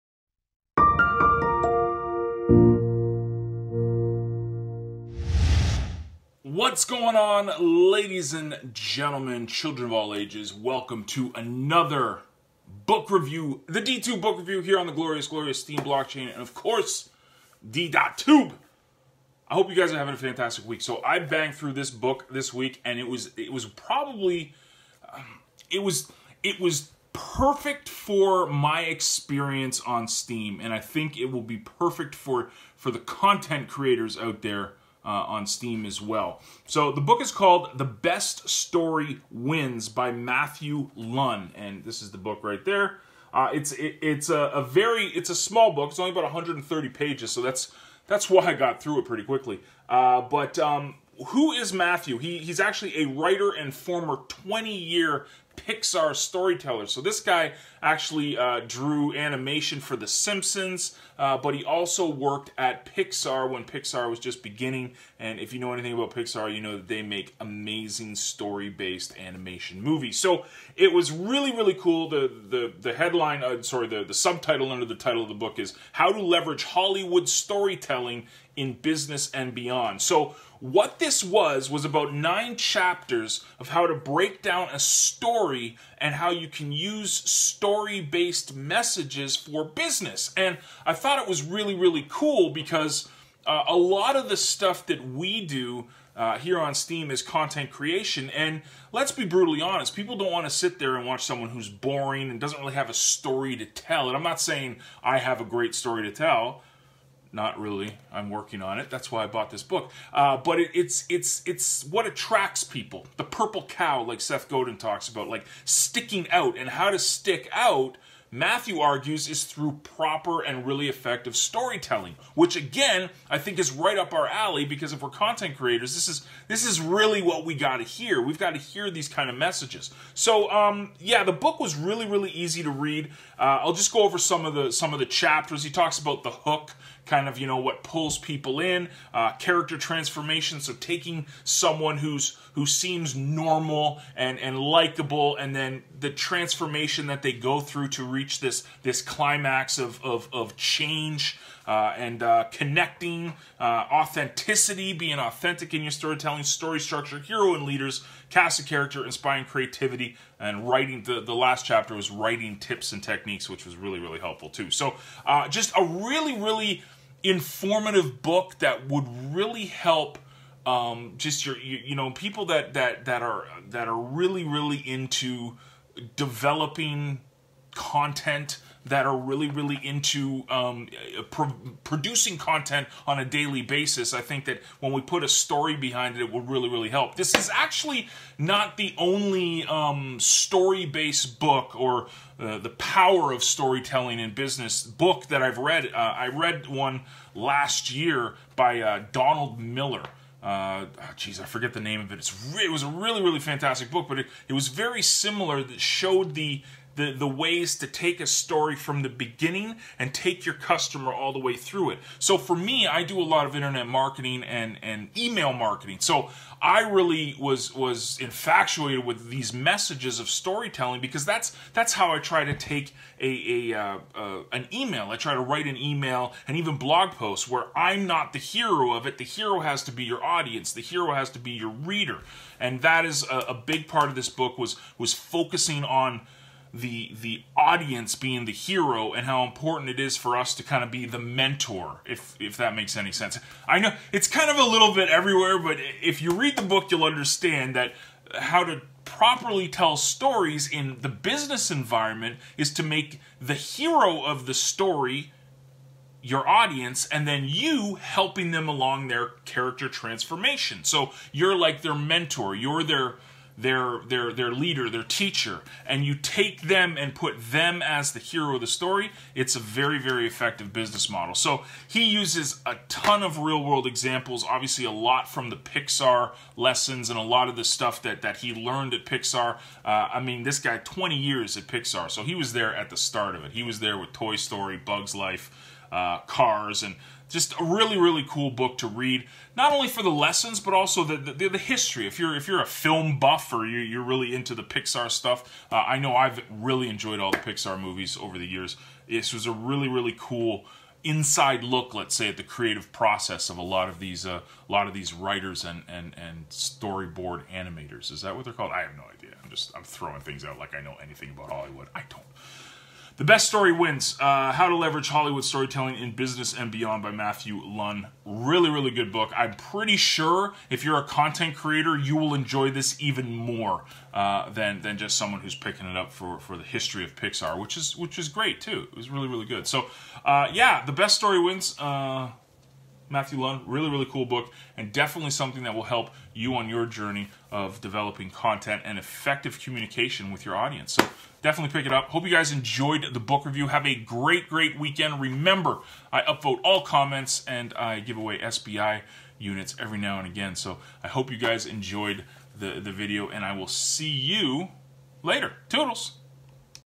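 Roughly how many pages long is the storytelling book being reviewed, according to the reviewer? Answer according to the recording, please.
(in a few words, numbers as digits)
130.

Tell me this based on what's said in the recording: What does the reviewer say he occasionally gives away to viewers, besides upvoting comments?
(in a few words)
SBI units.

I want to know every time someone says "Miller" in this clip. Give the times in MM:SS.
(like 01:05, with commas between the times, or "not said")
03:19.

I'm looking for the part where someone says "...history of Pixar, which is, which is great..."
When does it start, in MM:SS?
05:26.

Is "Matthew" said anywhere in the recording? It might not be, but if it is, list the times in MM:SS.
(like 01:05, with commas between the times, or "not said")
00:40, 00:51, 01:58, 05:17, 05:33.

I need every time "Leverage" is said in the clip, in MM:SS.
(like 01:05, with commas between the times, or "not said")
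01:16, 05:14.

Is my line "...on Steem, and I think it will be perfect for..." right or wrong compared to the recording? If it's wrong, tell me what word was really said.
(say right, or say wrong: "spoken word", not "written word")
right.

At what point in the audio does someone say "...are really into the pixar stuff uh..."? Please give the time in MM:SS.
04:53.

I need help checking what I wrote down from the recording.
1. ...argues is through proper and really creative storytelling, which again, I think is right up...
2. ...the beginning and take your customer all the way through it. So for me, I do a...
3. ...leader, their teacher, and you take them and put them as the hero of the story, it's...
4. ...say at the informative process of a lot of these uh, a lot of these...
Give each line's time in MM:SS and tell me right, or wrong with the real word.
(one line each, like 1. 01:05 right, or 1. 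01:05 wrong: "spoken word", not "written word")
1. 01:58 wrong: "effective", not "creative"
2. 03:29 right
3. 04:24 right
4. 05:02 wrong: "creative", not "informative".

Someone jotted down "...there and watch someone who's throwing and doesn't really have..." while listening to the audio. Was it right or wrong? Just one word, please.
wrong.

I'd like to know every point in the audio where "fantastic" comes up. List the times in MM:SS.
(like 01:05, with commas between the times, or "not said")
00:20, 03:23.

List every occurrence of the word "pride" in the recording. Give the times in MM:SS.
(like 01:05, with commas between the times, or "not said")
not said.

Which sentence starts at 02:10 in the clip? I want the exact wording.
So, um, yeah, the book was really really easy to read.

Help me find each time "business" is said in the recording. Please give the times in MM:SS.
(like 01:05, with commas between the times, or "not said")
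01:18, 01:29, 03:14, 04:11, 04:30, 05:16.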